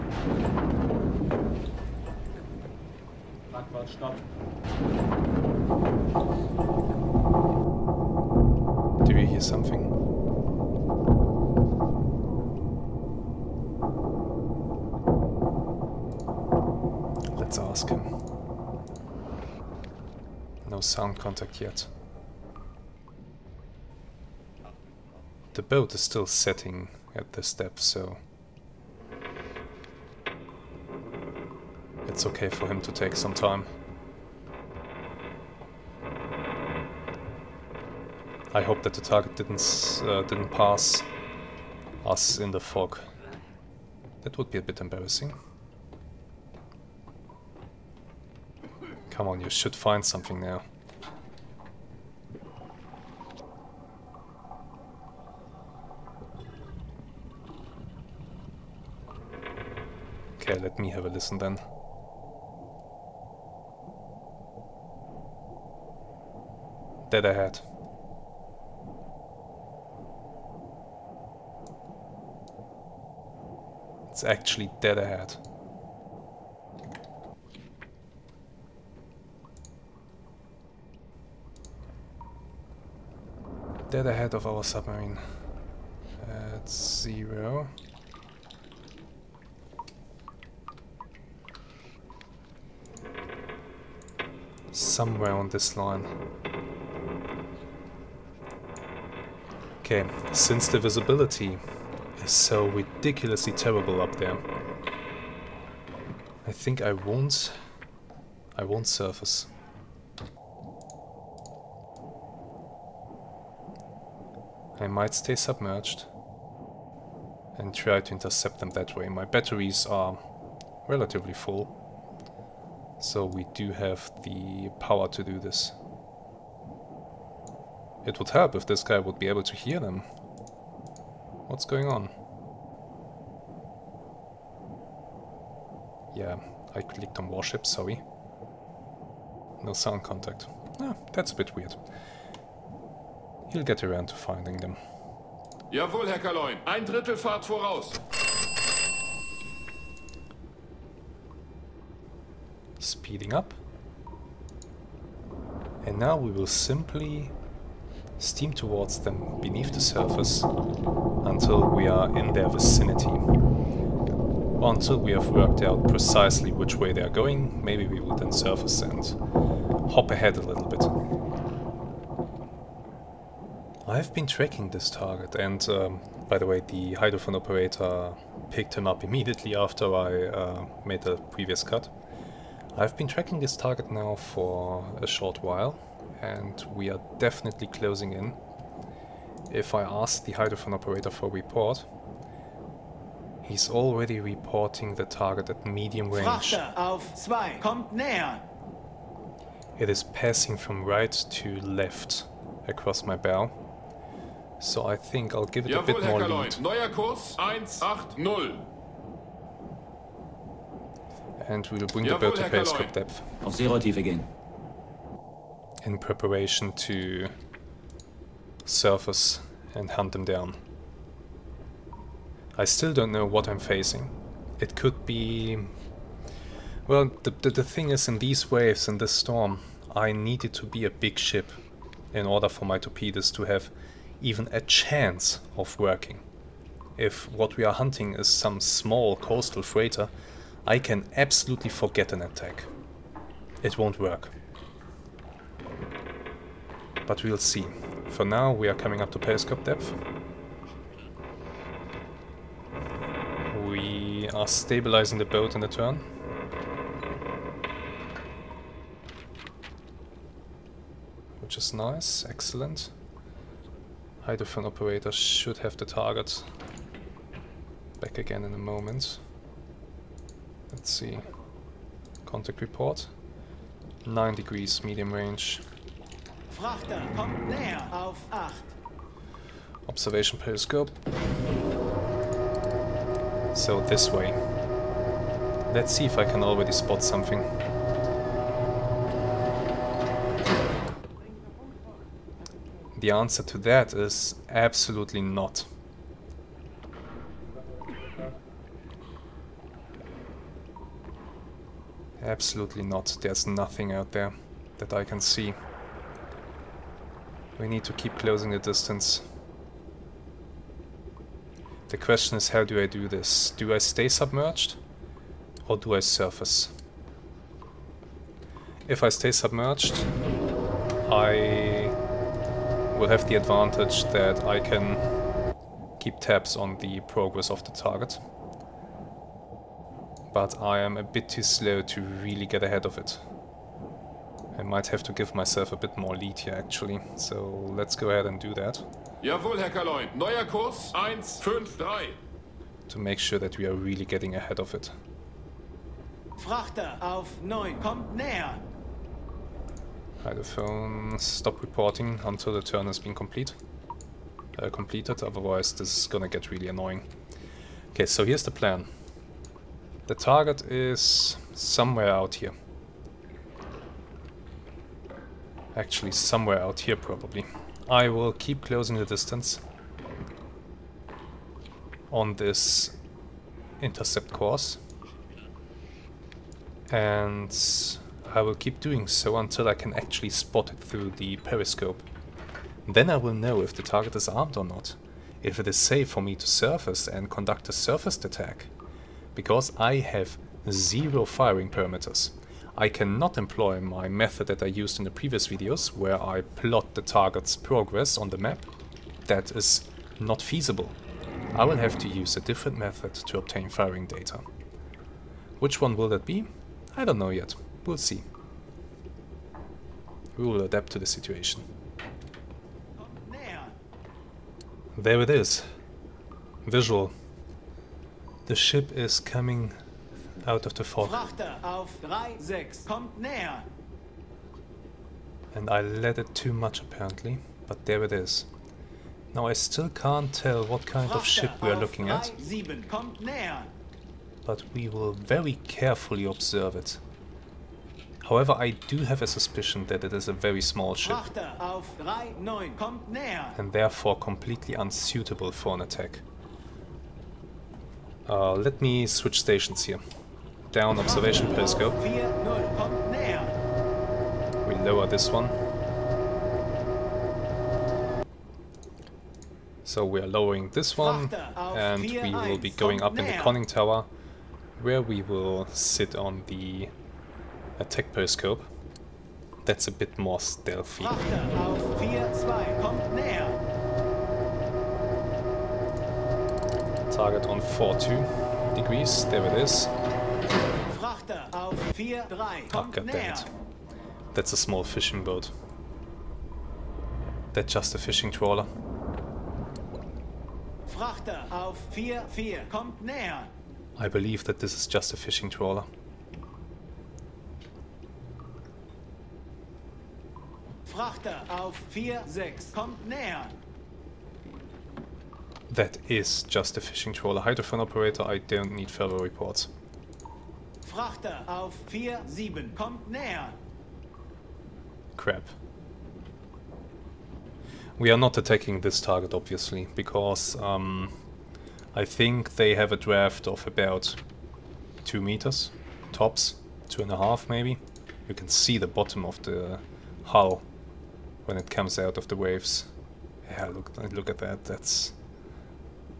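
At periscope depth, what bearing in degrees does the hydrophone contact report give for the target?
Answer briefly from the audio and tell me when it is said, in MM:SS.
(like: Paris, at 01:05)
9 degrees, at 04:34.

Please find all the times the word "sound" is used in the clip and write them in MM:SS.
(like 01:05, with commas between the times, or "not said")
00:20, 02:19.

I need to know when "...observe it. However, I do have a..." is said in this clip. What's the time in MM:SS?
07:16.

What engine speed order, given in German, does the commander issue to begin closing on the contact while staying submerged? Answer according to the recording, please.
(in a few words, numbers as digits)
Ein Drittel Fahrt voraus.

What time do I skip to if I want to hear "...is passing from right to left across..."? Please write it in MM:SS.
03:19.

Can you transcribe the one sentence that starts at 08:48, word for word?
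You can see the bottom of the hull when it comes out of the waves.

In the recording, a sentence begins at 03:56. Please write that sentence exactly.
If what we are hunting is some small coastal freighter, I can absolutely forget an attack.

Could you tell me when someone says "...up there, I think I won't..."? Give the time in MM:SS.
01:43.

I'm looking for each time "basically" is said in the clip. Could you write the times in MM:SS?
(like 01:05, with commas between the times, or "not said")
not said.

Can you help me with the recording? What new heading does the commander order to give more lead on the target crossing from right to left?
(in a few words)
180.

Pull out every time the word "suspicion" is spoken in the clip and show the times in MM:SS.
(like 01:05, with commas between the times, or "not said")
07:19.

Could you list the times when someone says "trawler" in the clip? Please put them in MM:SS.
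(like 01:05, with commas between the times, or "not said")
08:08, 08:15, 08:27.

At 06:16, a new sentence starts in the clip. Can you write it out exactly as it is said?
And I will keep doing so until I can actually spot it through the periscope.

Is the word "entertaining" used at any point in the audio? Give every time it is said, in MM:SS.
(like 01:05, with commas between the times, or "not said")
not said.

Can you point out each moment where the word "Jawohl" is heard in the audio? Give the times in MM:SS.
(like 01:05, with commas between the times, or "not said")
02:25, 03:25, 03:32, 05:39.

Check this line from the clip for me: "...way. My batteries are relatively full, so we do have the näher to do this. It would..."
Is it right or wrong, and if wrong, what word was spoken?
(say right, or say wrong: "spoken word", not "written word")
wrong: "power", not "näher".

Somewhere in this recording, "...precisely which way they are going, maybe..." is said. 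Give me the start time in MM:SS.
02:45.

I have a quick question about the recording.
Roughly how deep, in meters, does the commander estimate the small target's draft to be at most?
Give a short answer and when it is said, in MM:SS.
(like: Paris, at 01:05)
2 meters, at 08:45.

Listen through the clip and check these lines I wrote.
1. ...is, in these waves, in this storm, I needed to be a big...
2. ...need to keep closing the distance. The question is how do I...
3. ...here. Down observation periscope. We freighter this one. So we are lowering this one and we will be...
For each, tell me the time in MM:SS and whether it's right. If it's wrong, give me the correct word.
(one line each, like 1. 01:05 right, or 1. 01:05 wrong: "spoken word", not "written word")
1. 03:47 right
2. 05:07 right
3. 07:29 wrong: "lower", not "freighter".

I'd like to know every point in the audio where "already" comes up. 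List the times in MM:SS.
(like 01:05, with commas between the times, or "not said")
03:13, 04:46.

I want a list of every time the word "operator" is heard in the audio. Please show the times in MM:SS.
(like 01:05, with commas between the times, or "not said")
02:57, 03:10, 04:24, 08:27.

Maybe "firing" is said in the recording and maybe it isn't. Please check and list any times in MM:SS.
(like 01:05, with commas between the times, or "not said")
06:31, 06:43.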